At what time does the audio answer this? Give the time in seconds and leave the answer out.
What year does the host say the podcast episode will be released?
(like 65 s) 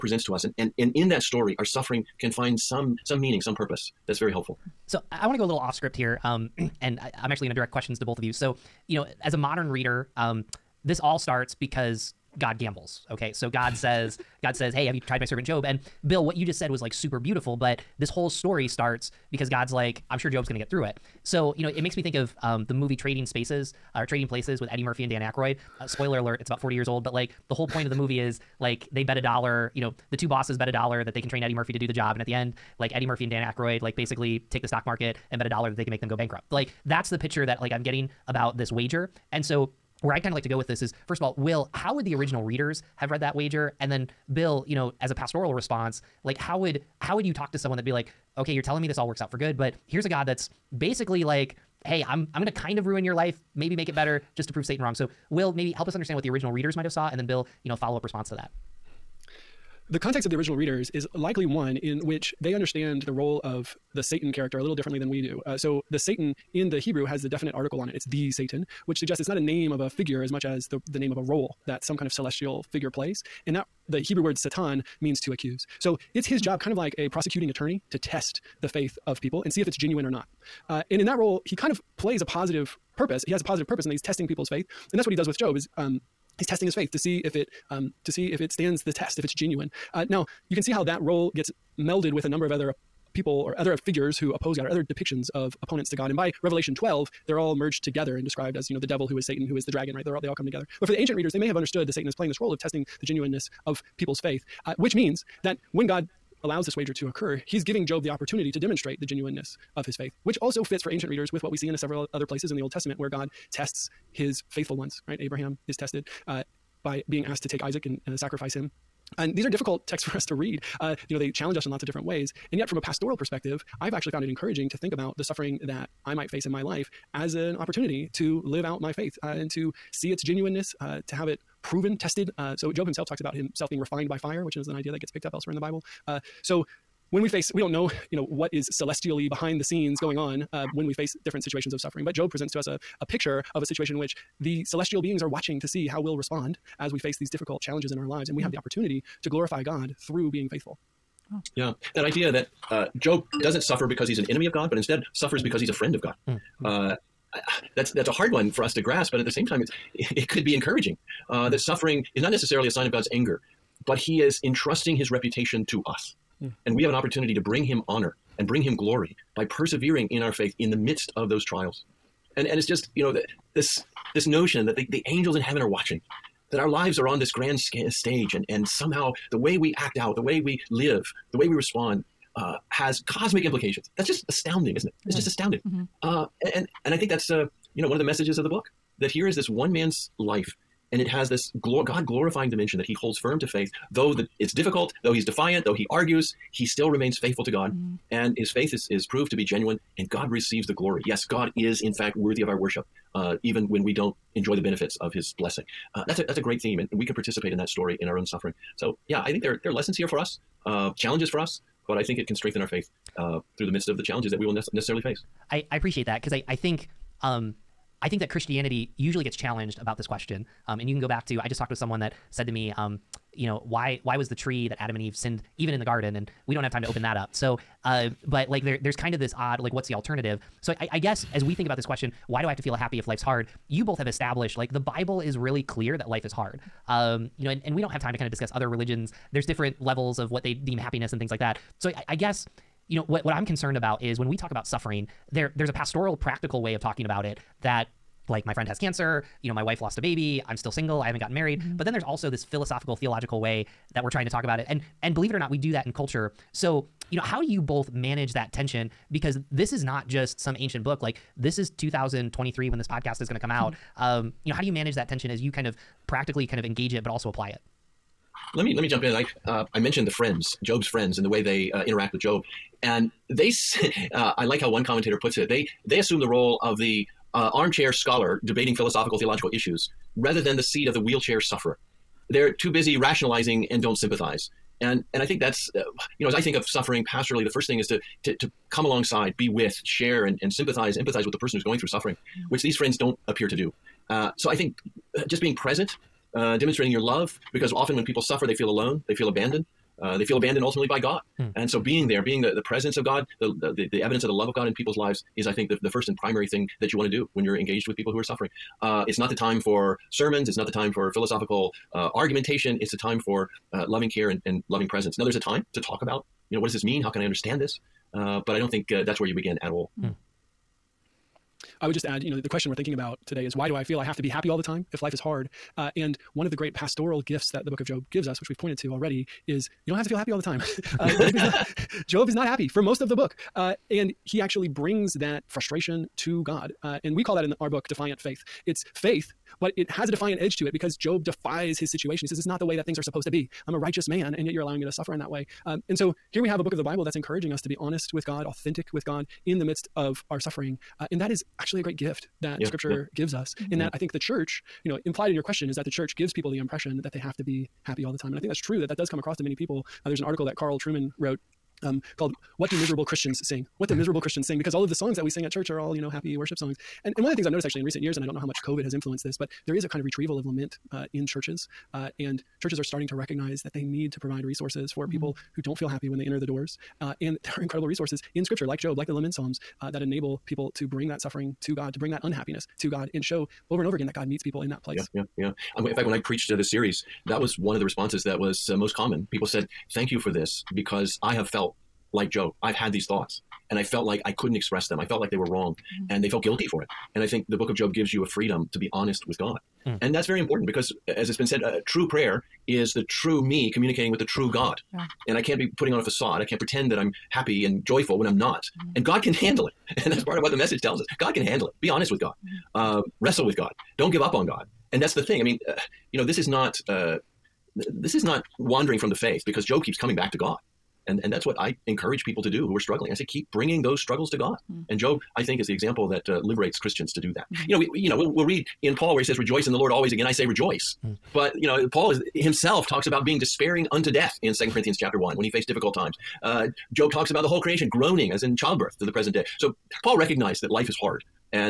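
261 s.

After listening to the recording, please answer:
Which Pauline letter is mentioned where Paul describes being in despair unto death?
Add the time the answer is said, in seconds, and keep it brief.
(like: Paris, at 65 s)
Second Corinthians, at 434 s.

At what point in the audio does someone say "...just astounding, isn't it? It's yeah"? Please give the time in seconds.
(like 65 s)
184 s.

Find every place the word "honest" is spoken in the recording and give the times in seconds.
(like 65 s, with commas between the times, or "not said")
347 s, 398 s, 411 s.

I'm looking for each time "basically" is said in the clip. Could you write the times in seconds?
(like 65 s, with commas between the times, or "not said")
33 s, 50 s.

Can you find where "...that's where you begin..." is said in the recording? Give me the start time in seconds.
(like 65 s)
319 s.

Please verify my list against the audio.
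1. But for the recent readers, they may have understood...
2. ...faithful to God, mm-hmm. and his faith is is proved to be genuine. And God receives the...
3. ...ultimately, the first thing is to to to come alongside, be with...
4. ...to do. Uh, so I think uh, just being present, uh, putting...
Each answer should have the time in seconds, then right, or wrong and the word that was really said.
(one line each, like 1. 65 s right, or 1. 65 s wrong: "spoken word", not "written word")
1. 100 s wrong: "ancient", not "recent"
2. 197 s right
3. 287 s wrong: "pastorally", not "ultimately"
4. 293 s wrong: "demonstrating", not "putting".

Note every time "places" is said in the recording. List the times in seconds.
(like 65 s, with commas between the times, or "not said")
24 s, 112 s, 384 s.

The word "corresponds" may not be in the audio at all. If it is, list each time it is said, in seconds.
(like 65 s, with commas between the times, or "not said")
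not said.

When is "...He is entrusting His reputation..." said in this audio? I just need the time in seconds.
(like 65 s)
163 s.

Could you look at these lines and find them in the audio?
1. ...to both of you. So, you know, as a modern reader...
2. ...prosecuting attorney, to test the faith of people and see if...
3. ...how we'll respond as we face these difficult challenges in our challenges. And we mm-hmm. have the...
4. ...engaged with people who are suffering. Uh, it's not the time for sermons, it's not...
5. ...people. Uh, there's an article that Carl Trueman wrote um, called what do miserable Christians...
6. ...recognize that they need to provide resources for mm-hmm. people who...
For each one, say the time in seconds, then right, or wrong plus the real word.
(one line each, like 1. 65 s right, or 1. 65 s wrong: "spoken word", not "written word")
1. 7 s right
2. 77 s right
3. 145 s wrong: "lives", not "challenges"
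4. 307 s right
5. 359 s right
6. 373 s right.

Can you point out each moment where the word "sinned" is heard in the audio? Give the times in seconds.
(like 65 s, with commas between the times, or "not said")
225 s.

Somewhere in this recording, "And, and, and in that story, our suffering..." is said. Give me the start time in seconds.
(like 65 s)
0 s.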